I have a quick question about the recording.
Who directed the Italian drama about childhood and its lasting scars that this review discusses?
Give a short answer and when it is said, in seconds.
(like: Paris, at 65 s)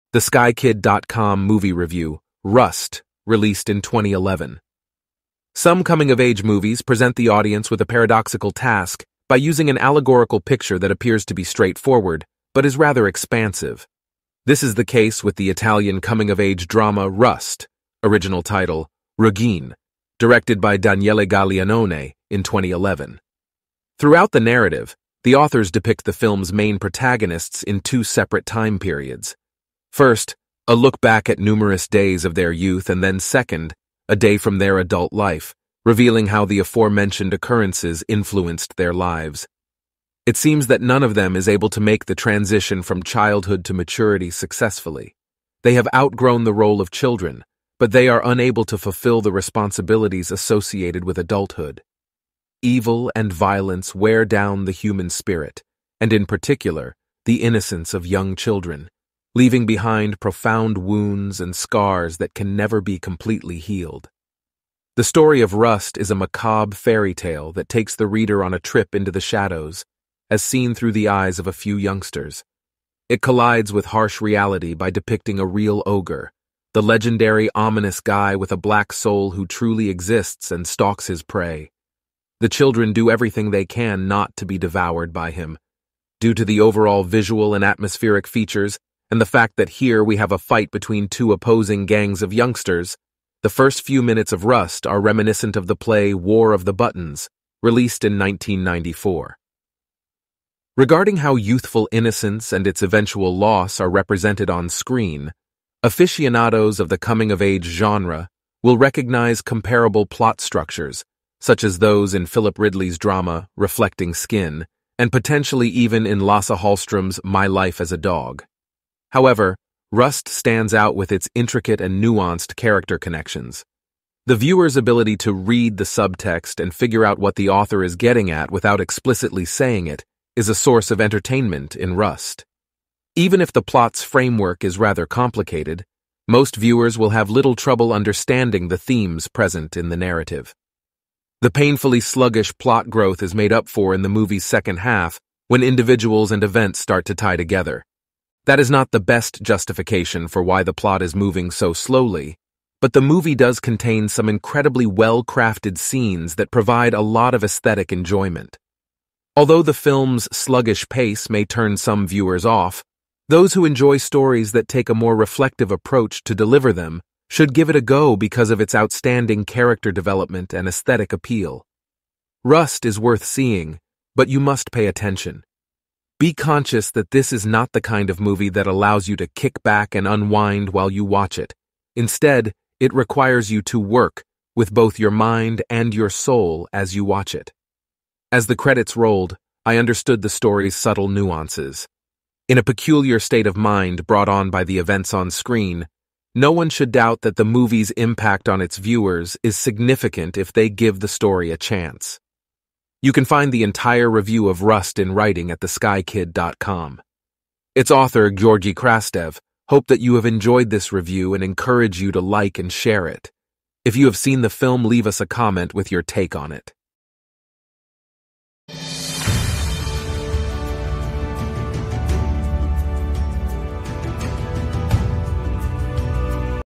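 Daniele Gaglianone, at 20 s.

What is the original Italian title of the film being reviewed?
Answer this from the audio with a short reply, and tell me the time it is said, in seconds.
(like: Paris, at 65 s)
Ruggine, at 19 s.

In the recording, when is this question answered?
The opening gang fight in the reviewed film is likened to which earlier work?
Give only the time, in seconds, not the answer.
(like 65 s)
96 s.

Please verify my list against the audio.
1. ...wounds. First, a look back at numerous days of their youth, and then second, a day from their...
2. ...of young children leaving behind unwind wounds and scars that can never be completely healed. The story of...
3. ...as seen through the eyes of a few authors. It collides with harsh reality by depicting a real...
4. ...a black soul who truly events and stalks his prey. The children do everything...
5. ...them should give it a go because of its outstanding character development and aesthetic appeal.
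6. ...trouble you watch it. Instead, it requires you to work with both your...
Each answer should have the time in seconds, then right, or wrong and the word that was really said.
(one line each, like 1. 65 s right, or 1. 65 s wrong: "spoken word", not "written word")
1. 28 s wrong: "periods", not "wounds"
2. 57 s wrong: "profound", not "unwind"
3. 70 s wrong: "youngsters", not "authors"
4. 78 s wrong: "exists", not "events"
5. 166 s right
6. 180 s wrong: "while", not "trouble".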